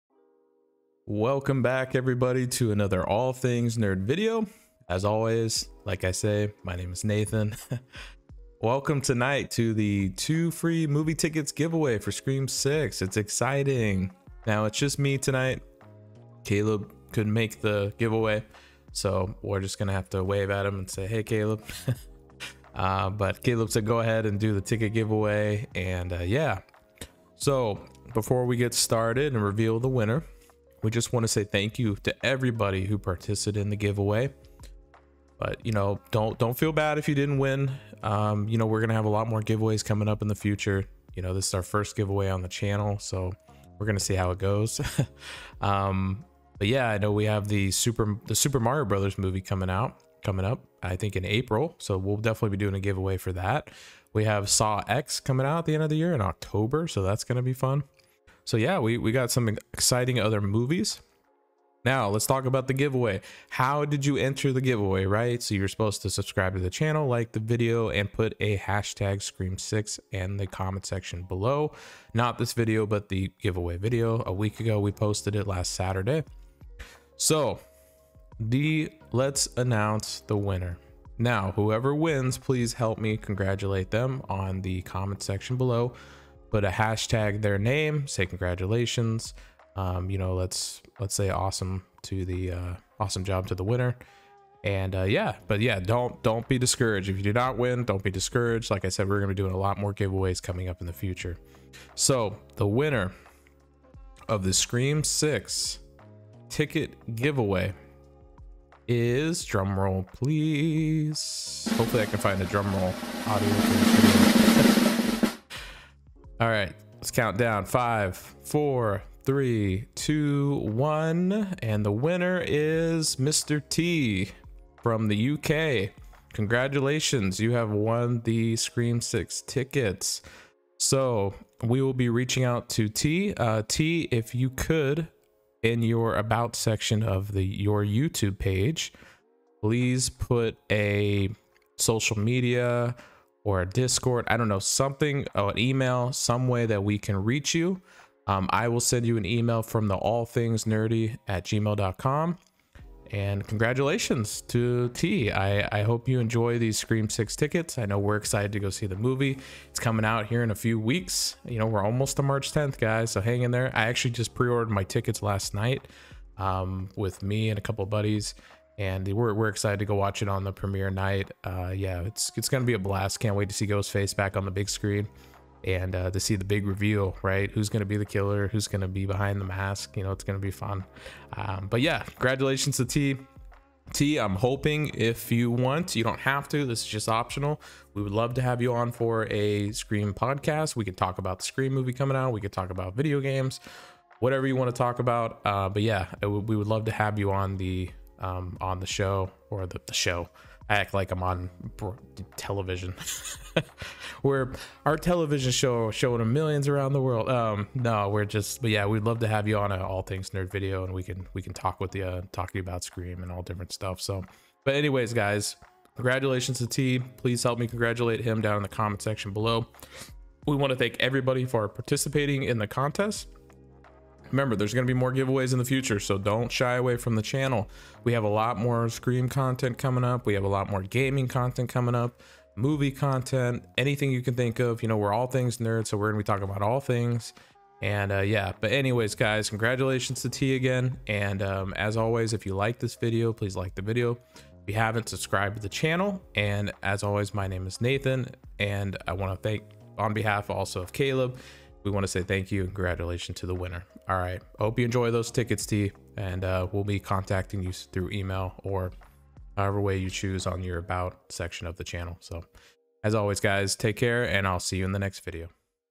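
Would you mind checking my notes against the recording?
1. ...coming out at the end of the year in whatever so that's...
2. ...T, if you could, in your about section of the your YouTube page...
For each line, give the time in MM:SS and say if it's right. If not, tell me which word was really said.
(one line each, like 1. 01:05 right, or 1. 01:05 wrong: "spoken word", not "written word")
1. 00:55 wrong: "october", not "whatever"
2. 02:13 right.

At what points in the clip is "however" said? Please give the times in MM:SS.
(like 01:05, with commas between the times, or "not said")
04:19.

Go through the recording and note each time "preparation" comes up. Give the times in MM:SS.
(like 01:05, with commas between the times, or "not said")
not said.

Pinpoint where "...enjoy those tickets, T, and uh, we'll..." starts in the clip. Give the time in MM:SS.
04:14.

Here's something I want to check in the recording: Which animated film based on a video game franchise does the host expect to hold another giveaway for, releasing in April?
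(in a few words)
The Super Mario Brothers Movie.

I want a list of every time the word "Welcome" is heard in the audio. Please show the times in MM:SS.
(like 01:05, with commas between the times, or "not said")
00:01, 00:08.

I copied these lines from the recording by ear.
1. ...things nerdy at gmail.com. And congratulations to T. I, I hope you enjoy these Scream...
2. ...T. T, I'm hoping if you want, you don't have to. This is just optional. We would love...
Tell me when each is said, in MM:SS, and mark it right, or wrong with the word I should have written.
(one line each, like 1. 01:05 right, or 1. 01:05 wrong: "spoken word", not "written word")
1. 02:30 right
2. 03:02 right.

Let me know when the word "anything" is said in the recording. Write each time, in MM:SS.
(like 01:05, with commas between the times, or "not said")
03:53.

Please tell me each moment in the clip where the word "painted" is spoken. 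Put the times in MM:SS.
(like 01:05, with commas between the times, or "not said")
not said.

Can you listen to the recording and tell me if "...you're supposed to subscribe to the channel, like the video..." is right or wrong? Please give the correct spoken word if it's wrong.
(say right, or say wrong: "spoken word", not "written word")
right.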